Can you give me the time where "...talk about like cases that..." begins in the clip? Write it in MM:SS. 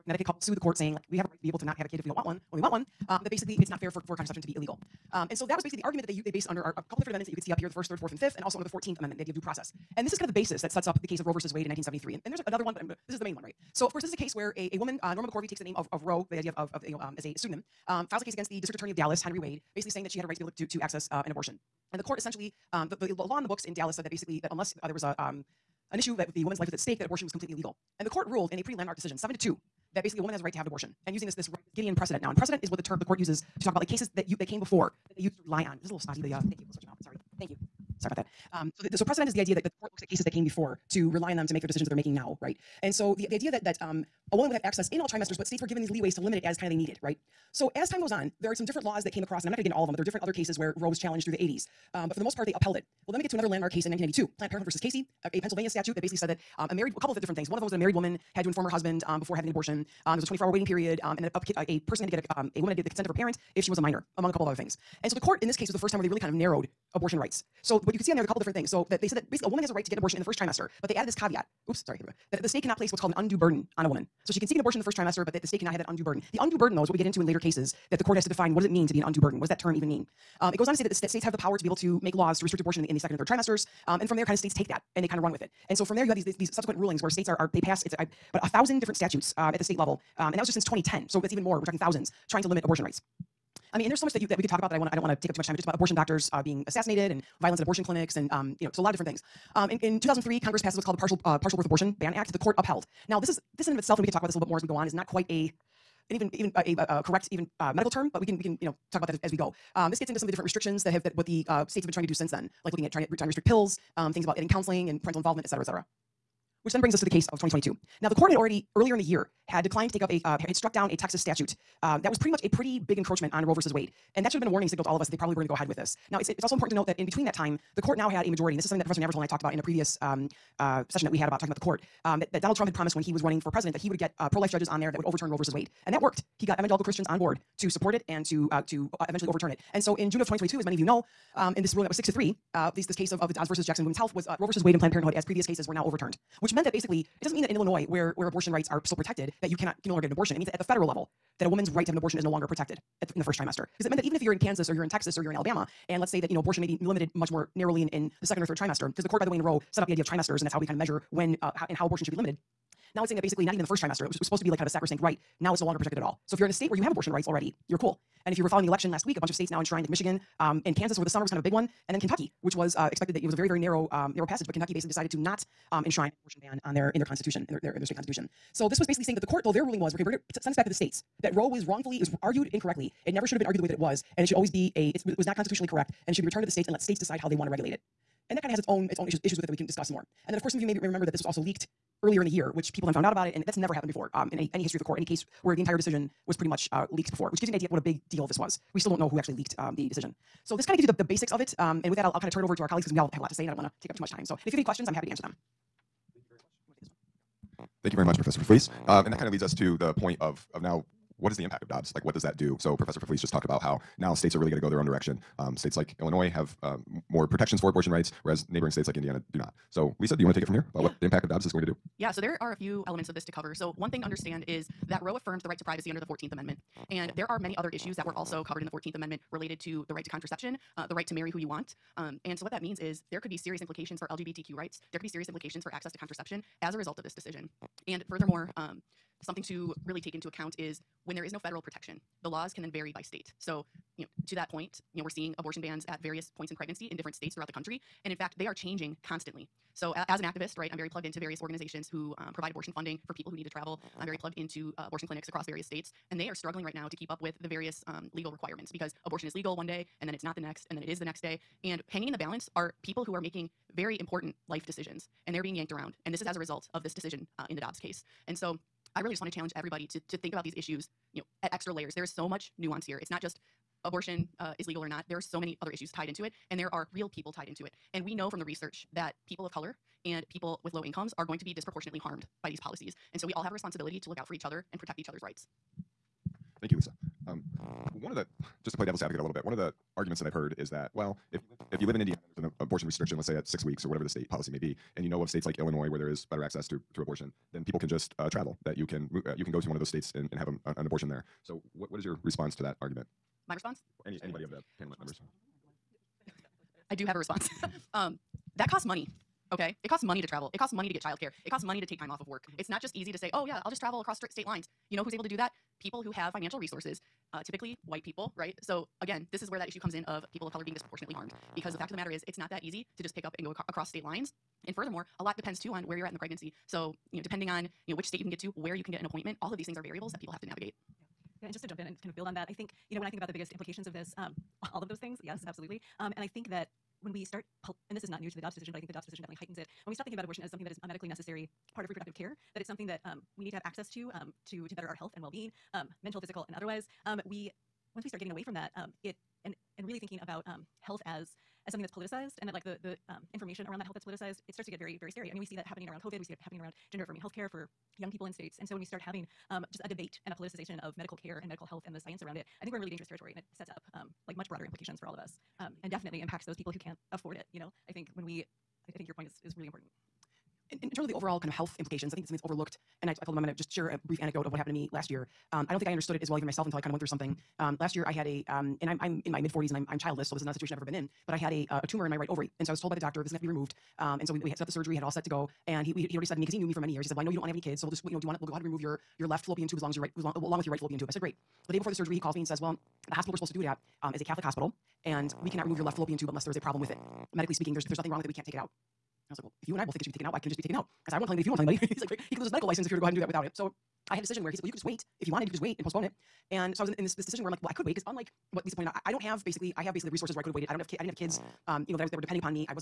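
00:33.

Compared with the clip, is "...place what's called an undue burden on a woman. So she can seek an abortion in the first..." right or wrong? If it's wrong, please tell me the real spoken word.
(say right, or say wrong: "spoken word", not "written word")
right.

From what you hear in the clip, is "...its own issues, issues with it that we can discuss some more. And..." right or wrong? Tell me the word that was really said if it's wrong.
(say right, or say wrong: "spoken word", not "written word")
right.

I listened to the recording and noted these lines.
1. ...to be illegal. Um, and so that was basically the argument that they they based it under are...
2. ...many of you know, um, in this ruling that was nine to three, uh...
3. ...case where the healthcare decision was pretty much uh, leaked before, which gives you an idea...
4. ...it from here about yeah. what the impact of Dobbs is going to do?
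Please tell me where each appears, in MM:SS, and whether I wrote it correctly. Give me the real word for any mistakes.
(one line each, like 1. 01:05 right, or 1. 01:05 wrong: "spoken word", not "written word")
1. 00:04 right
2. 02:20 wrong: "six", not "nine"
3. 03:15 wrong: "entire", not "healthcare"
4. 03:40 right.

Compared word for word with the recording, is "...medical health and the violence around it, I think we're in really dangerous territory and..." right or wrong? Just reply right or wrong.
wrong.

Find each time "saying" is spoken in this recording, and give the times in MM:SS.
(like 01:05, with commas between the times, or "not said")
00:00, 00:19, 02:43, 02:59.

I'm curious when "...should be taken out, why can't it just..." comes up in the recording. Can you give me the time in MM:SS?
06:40.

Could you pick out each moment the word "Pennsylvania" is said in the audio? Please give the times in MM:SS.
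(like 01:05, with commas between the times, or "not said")
00:55.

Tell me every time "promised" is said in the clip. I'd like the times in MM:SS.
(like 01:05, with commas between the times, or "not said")
02:12.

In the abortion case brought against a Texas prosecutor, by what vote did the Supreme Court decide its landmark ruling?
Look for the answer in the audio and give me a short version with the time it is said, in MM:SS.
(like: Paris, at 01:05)
7 to 2, at 00:29.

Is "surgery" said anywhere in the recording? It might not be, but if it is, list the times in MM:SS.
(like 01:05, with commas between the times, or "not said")
06:24, 06:31.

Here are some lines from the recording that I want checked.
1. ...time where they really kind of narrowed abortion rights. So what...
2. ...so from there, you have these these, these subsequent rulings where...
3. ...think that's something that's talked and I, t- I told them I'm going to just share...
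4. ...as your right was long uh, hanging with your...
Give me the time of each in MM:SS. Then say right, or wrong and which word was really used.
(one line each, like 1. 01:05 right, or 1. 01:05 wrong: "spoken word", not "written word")
1. 01:05 right
2. 01:25 right
3. 06:12 wrong: "overlooked", not "talked"
4. 06:29 wrong: "along", not "hanging".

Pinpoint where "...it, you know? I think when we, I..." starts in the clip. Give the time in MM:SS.
06:07.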